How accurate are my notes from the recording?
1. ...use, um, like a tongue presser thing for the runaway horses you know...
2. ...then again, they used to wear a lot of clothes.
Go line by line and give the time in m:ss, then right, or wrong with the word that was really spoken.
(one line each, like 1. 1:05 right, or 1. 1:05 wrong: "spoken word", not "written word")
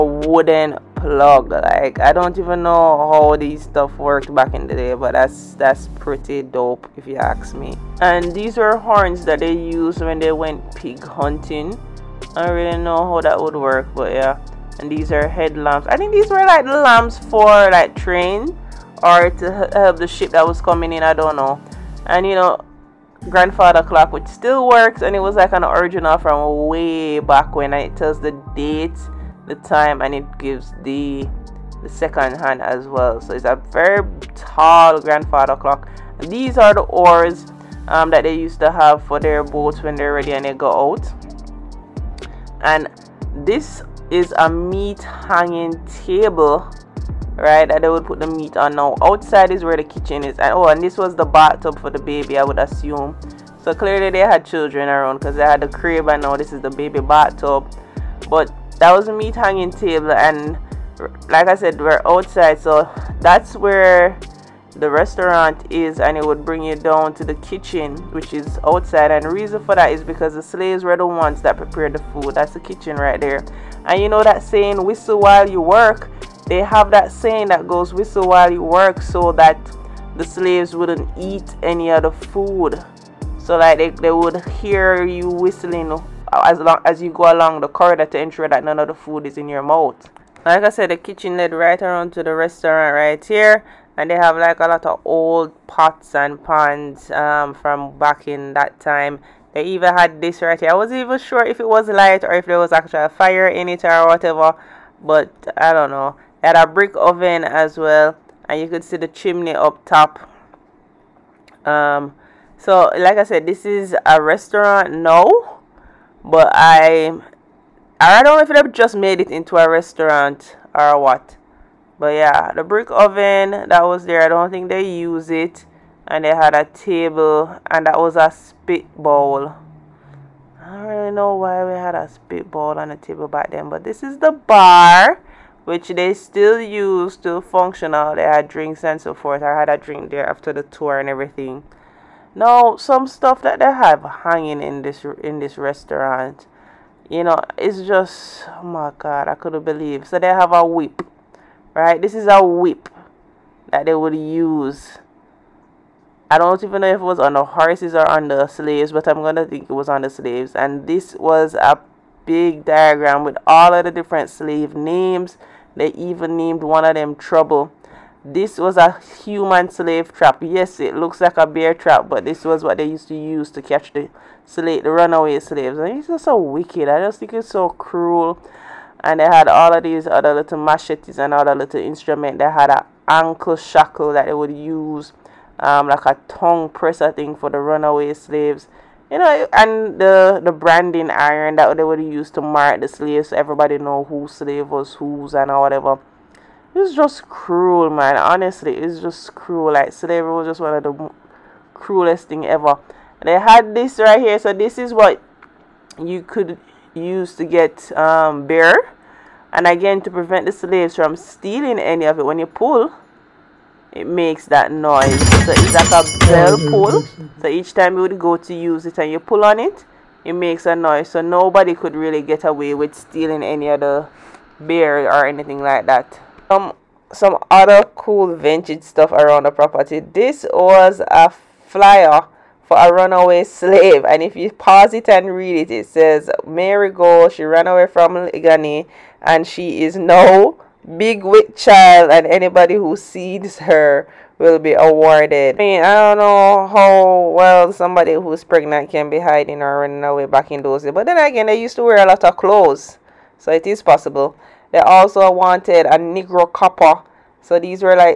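1. 3:04 wrong: "slaves", not "horses"
2. 4:11 right.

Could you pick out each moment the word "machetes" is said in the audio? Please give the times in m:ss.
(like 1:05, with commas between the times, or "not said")
3:00.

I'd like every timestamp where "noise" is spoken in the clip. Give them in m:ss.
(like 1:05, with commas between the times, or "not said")
3:34, 3:40.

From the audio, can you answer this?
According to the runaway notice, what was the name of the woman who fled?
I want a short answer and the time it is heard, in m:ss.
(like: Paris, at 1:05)
Mary Go, at 3:56.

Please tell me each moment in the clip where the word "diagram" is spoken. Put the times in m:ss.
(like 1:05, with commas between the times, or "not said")
2:42.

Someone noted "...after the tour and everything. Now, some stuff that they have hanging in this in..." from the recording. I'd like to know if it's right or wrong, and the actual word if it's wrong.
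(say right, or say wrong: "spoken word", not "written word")
right.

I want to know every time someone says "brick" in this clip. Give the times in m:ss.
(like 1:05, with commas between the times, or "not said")
1:46, 2:02.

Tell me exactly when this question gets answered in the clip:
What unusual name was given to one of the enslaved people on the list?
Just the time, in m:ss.
2:47.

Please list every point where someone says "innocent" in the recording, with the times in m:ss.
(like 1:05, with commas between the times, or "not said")
not said.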